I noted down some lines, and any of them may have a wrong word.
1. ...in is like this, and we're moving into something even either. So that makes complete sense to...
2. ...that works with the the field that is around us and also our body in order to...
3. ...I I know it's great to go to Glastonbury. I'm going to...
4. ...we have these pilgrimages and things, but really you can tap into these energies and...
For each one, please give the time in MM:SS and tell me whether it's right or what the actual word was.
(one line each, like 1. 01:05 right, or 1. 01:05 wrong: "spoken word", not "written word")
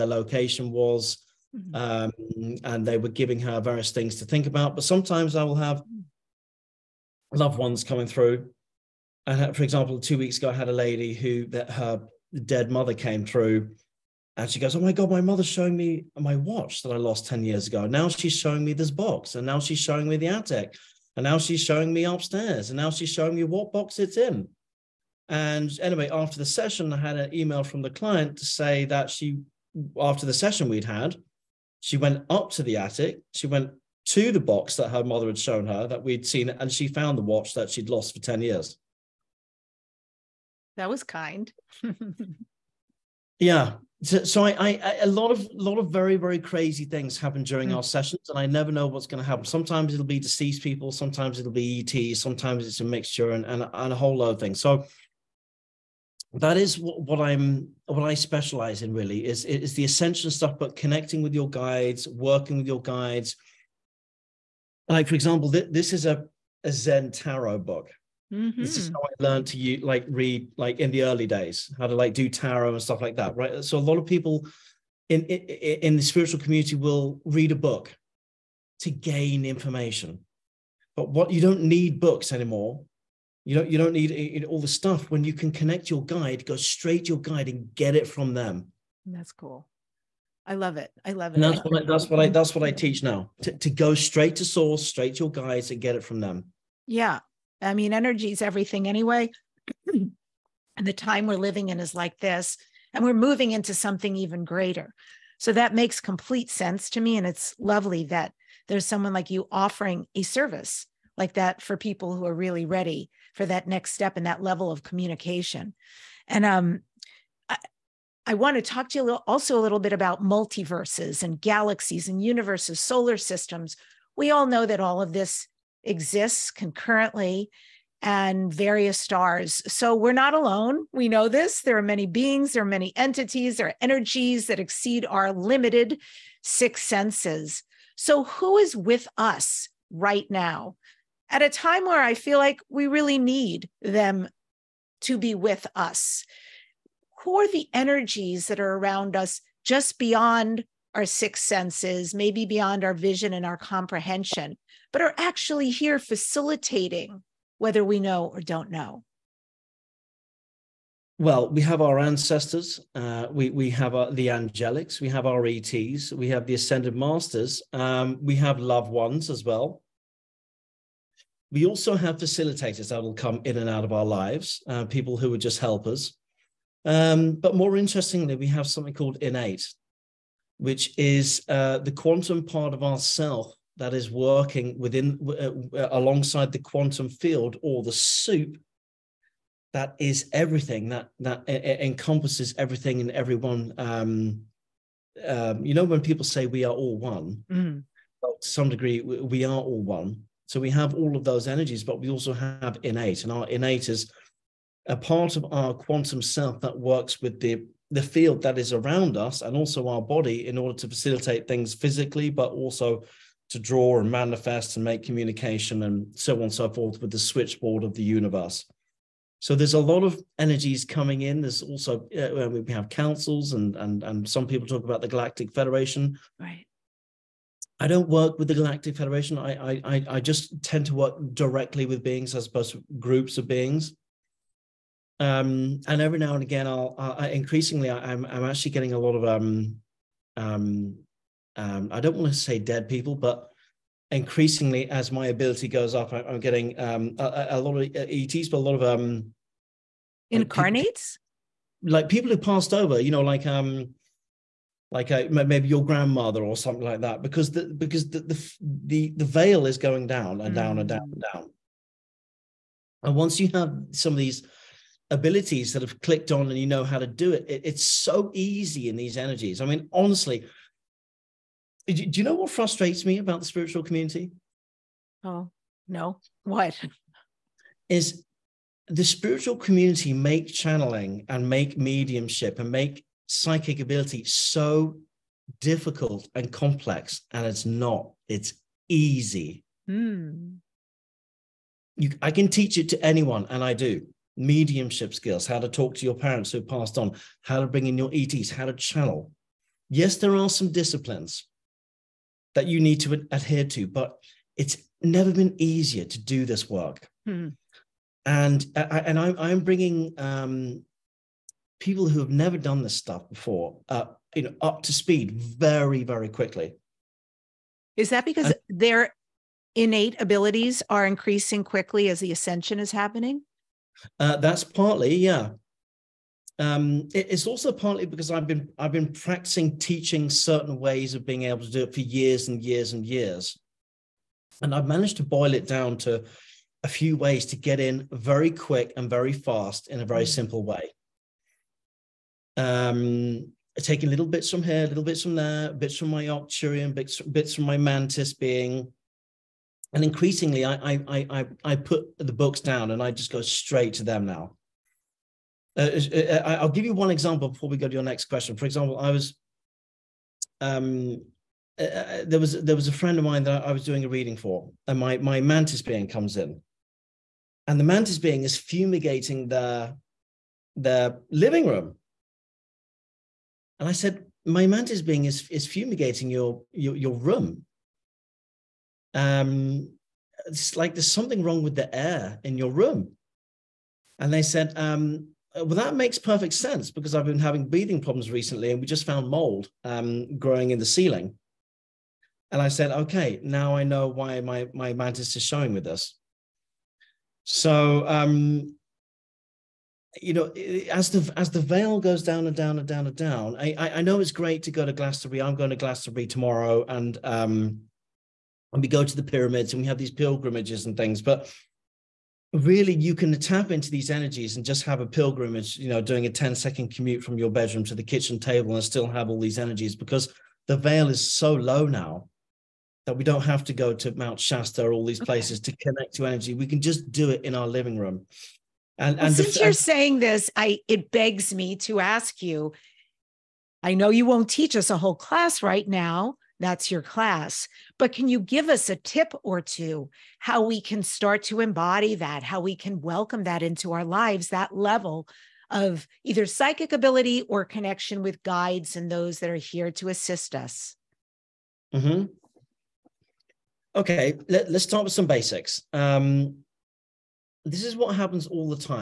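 1. 01:41 wrong: "greater", not "either"
2. 03:26 right
3. 06:43 right
4. 06:49 right.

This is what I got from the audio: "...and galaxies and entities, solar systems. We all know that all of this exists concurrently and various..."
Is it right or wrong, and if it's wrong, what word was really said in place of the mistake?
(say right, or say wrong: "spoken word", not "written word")
wrong: "universes", not "entities".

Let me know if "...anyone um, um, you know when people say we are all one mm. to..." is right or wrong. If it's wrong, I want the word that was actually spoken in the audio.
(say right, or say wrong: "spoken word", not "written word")
wrong: "everyone", not "anyone".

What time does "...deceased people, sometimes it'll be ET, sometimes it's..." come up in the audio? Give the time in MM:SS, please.
00:50.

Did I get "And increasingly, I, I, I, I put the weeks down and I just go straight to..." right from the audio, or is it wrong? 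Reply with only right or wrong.
wrong.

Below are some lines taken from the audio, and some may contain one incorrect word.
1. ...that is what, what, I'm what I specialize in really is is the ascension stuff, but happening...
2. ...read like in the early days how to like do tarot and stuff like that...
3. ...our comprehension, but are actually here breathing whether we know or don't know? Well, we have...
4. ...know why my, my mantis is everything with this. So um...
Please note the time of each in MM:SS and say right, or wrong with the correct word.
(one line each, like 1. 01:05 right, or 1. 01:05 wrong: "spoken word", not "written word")
1. 00:56 wrong: "connecting", not "happening"
2. 01:10 right
3. 02:33 wrong: "facilitating", not "breathing"
4. 06:33 wrong: "showing", not "everything".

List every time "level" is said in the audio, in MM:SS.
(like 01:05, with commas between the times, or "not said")
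01:54, 07:24.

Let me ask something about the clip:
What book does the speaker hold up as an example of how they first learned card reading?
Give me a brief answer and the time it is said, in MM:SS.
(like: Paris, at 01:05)
Zen tarot book, at 01:06.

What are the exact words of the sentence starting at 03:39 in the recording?
So there's a lot of energies coming in.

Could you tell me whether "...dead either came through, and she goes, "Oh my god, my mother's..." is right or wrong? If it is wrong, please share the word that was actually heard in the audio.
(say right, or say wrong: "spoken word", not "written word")
wrong: "mother", not "either".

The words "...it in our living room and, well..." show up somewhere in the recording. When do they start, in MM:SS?
07:07.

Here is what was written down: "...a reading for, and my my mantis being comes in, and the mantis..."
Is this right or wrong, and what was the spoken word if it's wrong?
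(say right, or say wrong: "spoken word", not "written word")
right.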